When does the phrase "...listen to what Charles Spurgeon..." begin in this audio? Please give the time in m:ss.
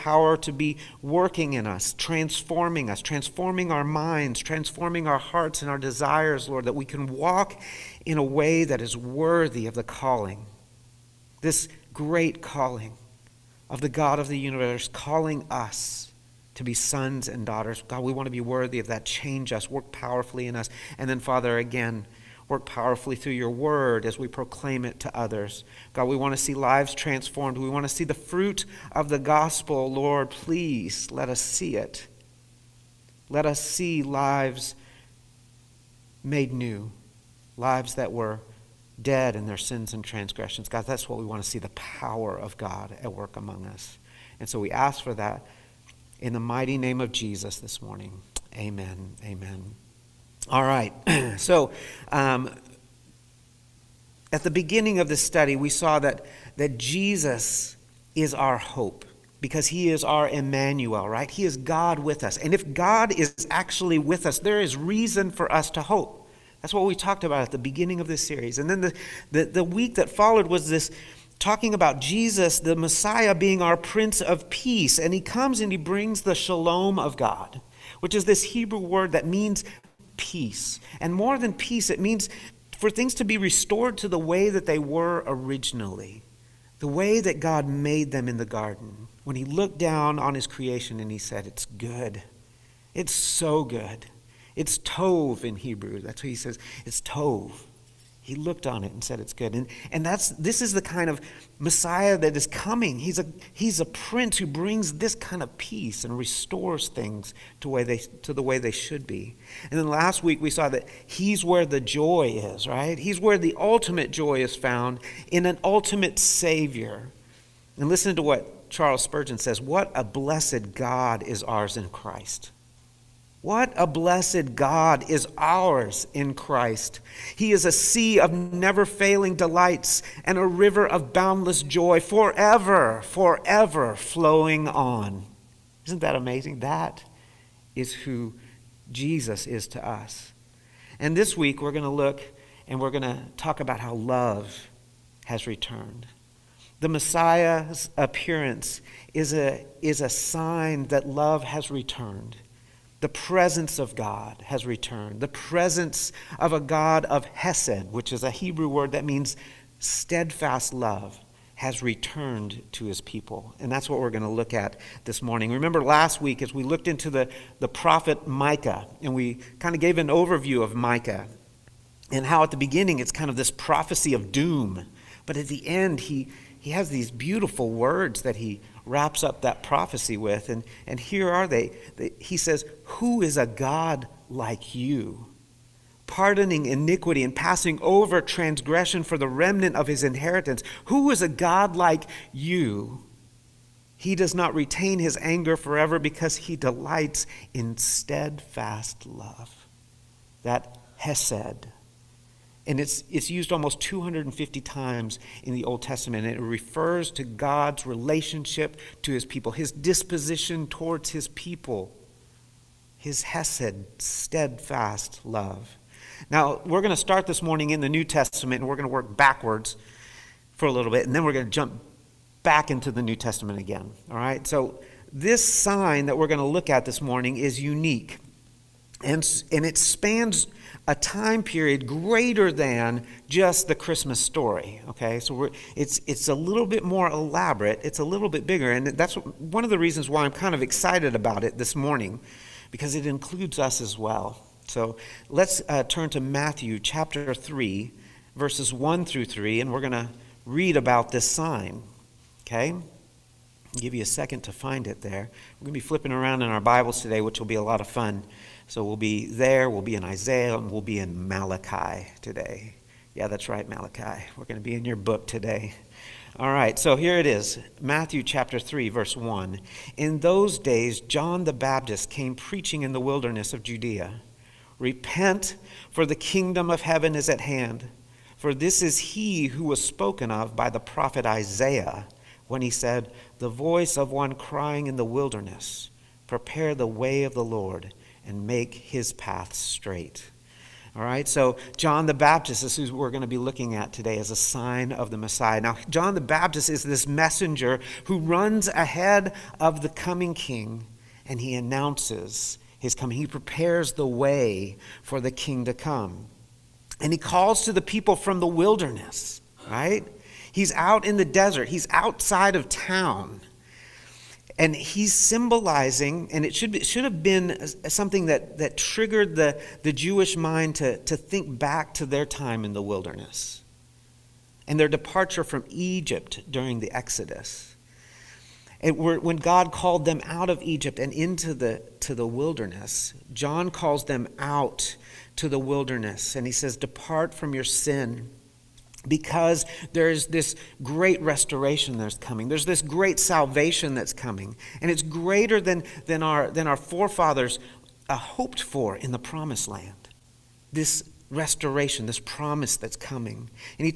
1:57.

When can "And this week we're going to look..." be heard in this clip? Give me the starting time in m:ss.
2:21.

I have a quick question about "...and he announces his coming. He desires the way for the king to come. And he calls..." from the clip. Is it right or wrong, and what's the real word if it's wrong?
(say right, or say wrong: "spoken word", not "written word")
wrong: "prepares", not "desires".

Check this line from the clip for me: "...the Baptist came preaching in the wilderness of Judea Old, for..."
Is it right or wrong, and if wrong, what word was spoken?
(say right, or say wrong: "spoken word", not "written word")
wrong: "Repent", not "Old".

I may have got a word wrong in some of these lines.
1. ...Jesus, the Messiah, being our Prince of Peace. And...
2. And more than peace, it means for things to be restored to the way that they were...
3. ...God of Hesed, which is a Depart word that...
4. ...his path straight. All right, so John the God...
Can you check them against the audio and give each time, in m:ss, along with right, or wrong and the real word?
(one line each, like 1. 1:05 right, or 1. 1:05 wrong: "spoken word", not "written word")
1. 1:11 right
2. 1:21 right
3. 2:36 wrong: "Hebrew", not "Depart"
4. 4:48 wrong: "Baptist", not "God".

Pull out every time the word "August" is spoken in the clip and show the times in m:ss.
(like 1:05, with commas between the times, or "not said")
not said.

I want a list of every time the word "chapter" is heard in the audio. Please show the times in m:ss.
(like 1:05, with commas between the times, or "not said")
4:06, 4:28.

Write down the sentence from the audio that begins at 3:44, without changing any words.
So, this sign that we're going to look at this morning is unique.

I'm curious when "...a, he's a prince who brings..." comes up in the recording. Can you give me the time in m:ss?
1:43.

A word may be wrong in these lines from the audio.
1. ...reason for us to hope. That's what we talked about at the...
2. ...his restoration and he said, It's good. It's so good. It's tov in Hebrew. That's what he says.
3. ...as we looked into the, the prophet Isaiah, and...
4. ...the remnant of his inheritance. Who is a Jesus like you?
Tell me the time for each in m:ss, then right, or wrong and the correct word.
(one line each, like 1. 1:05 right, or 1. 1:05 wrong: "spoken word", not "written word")
1. 1:04 right
2. 1:30 wrong: "creation", not "restoration"
3. 2:46 wrong: "Micah", not "Isaiah"
4. 3:09 wrong: "God", not "Jesus".